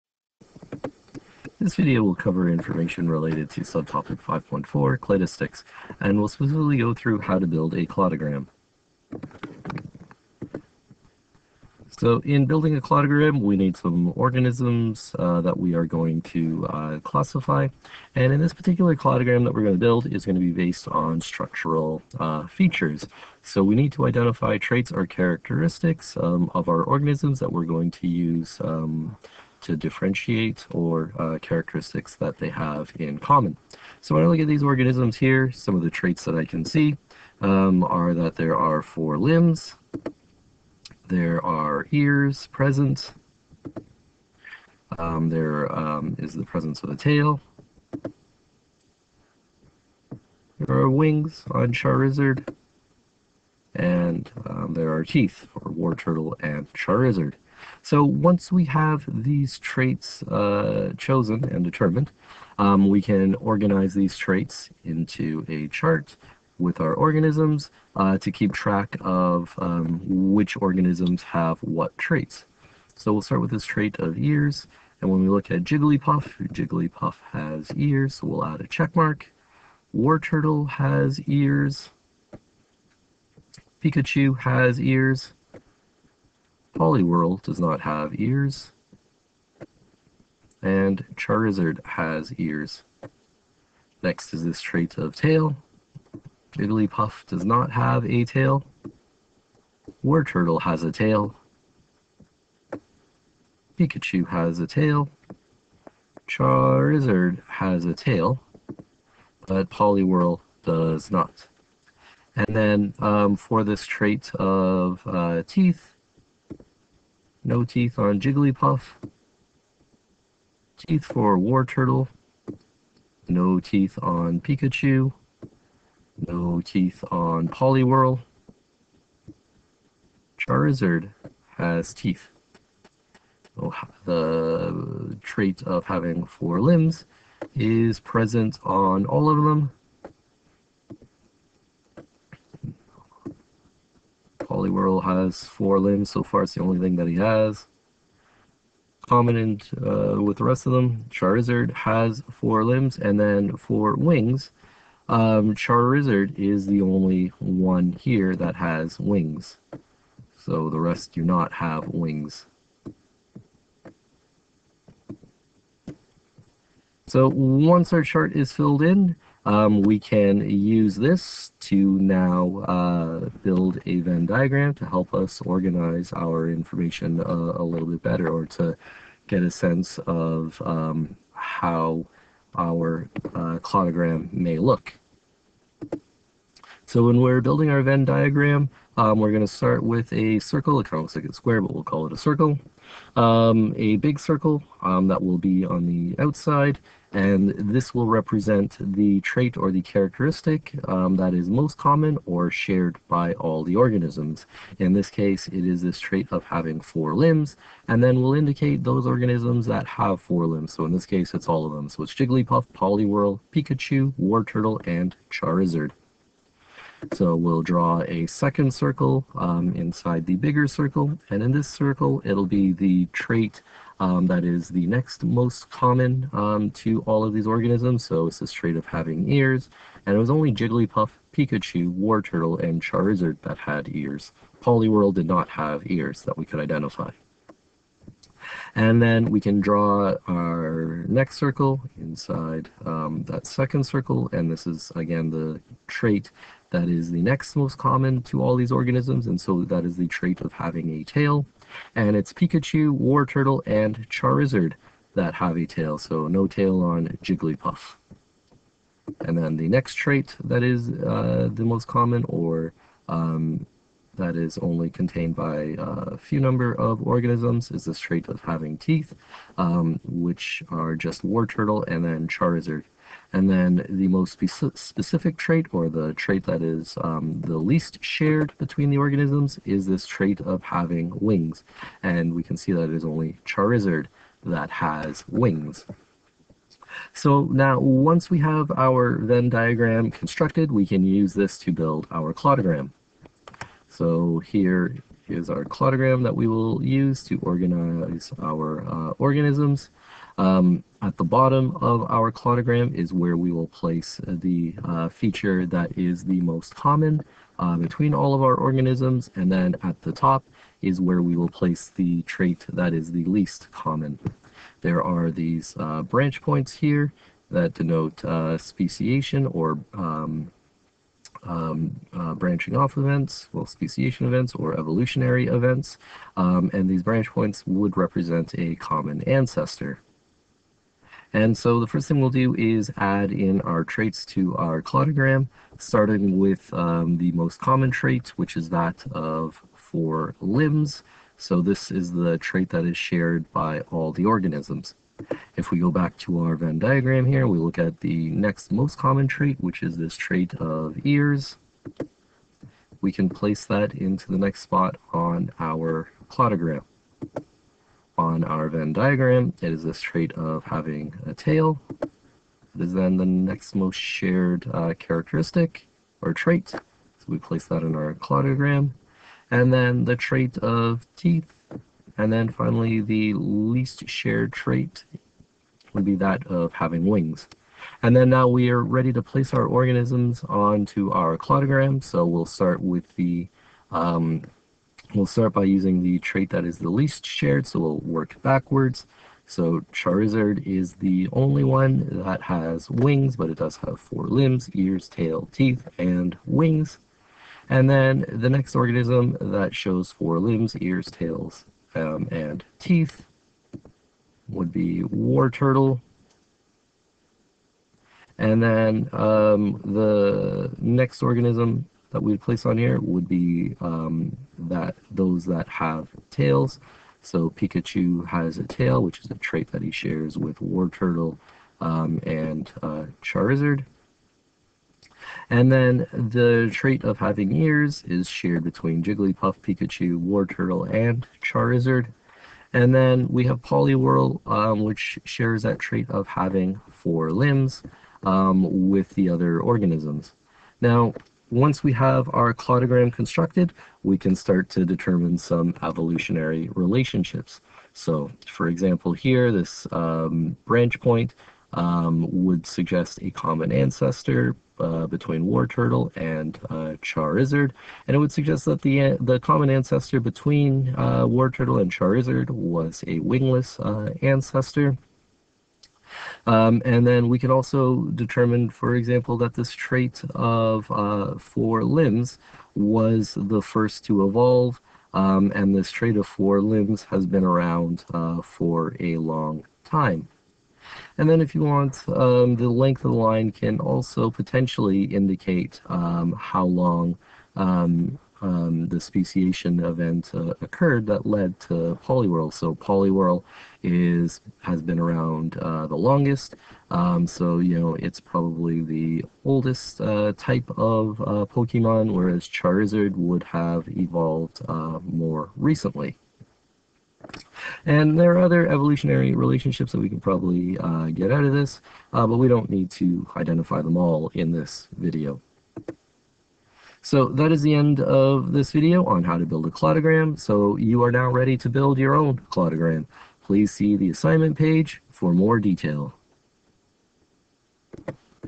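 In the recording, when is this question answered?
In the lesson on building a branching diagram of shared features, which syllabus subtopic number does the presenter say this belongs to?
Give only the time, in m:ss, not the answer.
0:04.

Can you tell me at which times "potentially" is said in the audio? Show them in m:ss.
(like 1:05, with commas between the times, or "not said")
8:04.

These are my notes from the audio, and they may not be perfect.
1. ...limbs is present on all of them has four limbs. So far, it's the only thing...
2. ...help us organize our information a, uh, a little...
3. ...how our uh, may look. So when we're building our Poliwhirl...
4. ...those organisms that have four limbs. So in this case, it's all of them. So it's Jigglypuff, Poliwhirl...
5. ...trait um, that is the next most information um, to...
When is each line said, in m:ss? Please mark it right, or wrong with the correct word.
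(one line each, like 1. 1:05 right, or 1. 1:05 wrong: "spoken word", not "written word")
1. 2:16 right
2. 2:54 right
3. 3:01 wrong: "Venn", not "Poliwhirl"
4. 3:28 right
5. 3:43 wrong: "common", not "information".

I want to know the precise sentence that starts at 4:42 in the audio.
And we can see that it is only Charizard that has wings.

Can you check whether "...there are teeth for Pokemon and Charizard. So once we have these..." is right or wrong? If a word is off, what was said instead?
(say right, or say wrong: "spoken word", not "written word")
wrong: "Wartortle", not "Pokemon".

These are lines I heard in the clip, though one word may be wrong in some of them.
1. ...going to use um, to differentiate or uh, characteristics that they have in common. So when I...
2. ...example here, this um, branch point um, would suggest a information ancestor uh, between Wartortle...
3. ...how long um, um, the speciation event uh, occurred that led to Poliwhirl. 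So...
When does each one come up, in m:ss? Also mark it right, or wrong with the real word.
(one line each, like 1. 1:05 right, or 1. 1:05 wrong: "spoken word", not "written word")
1. 0:27 right
2. 7:28 wrong: "common", not "information"
3. 8:06 right.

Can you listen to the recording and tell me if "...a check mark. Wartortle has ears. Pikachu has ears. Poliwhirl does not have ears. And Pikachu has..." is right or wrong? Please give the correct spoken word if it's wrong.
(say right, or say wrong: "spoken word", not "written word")
wrong: "Charizard", not "Pikachu".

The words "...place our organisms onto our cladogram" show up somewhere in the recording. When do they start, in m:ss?
6:19.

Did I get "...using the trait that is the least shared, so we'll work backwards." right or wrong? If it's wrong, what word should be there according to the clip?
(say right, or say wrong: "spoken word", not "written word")
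right.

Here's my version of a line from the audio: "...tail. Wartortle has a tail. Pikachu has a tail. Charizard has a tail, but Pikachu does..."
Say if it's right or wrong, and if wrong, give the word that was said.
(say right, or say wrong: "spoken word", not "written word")
wrong: "Poliwhirl", not "Pikachu".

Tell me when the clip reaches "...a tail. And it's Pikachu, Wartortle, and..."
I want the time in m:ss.
4:10.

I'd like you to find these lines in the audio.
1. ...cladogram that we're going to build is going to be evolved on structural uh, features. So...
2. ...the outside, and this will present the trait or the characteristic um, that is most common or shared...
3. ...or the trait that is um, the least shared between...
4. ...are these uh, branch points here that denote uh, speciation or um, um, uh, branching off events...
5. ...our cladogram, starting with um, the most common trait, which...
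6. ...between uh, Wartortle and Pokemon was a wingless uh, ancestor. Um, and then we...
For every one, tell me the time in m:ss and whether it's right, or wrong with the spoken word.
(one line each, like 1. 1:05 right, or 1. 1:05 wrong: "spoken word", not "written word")
1. 0:18 wrong: "based", not "evolved"
2. 3:15 wrong: "represent", not "present"
3. 4:35 right
4. 5:15 right
5. 5:34 right
6. 7:40 wrong: "Charizard", not "Pokemon".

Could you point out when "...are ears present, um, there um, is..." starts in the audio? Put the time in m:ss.
0:41.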